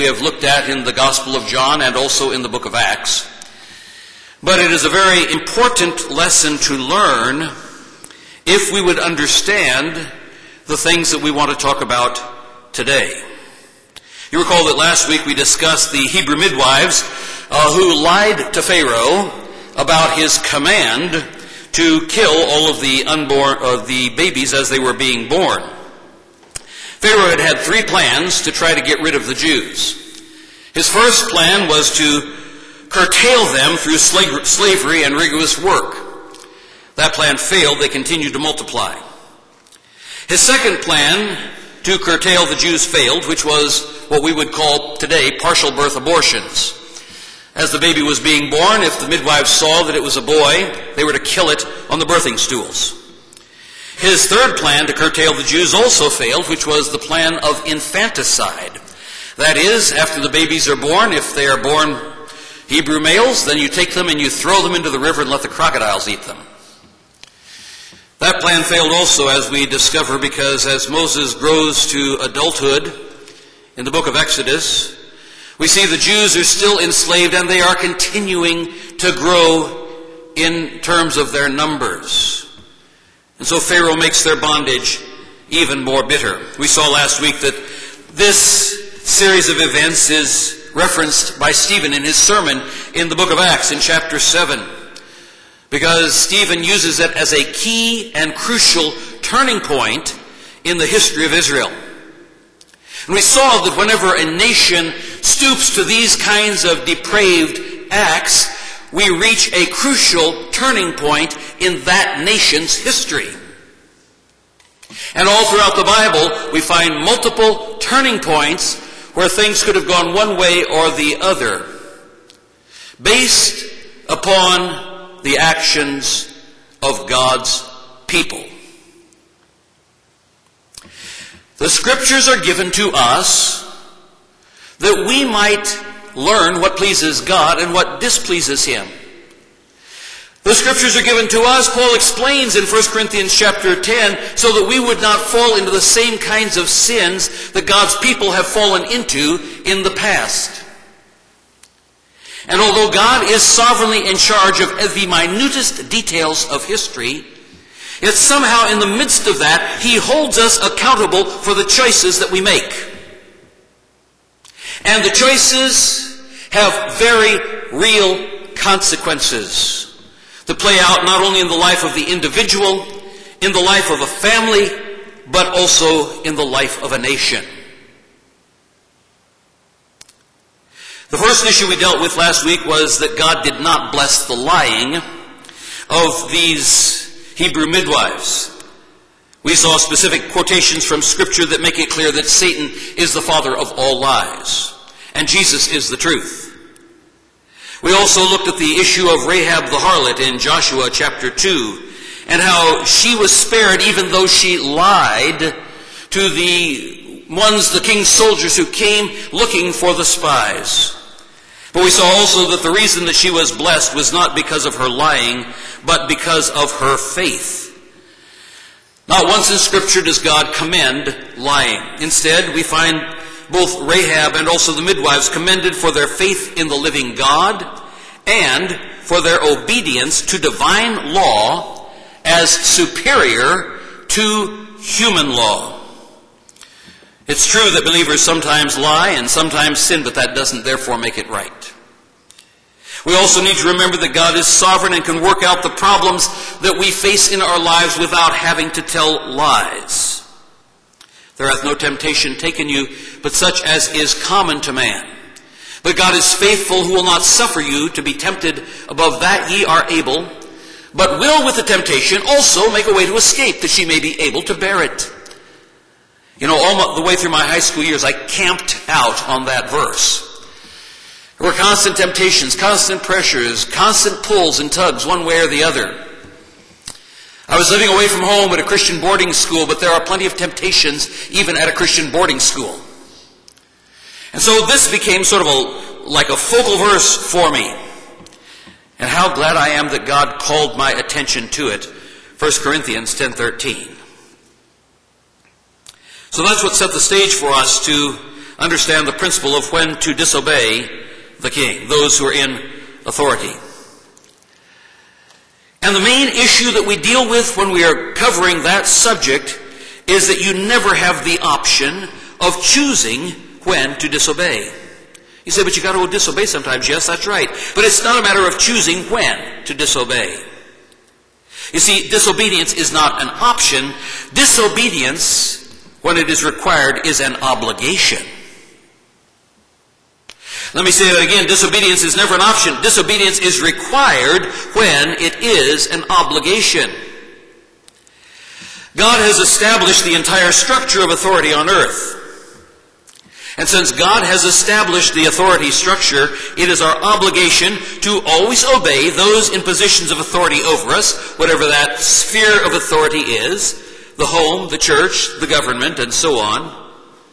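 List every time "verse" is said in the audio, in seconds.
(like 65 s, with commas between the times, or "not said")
269 s, 286 s.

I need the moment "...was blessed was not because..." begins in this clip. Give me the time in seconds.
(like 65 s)
213 s.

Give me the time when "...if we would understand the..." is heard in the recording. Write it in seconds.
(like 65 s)
8 s.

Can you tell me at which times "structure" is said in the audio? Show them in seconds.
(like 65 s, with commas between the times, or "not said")
340 s, 345 s.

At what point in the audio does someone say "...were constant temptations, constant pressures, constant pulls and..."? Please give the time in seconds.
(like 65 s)
271 s.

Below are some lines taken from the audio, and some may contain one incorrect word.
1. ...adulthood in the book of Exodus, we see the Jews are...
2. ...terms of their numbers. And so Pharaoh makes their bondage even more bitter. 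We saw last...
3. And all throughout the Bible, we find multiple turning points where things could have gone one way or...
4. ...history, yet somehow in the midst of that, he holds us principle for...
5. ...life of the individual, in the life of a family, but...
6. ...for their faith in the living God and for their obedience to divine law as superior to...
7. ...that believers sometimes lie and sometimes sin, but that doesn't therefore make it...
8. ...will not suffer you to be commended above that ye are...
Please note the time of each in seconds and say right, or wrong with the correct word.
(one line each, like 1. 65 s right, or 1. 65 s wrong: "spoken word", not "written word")
1. 72 s right
2. 80 s right
3. 115 s right
4. 156 s wrong: "accountable", not "principle"
5. 171 s right
6. 225 s right
7. 237 s right
8. 256 s wrong: "tempted", not "commended".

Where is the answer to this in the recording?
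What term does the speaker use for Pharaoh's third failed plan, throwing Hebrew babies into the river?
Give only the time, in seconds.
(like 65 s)
57 s.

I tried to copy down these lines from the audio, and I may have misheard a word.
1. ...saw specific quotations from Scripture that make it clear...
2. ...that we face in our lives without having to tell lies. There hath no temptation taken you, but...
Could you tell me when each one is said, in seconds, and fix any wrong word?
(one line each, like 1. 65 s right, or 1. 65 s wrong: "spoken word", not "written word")
1. 189 s right
2. 246 s right.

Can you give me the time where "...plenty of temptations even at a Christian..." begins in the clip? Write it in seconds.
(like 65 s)
280 s.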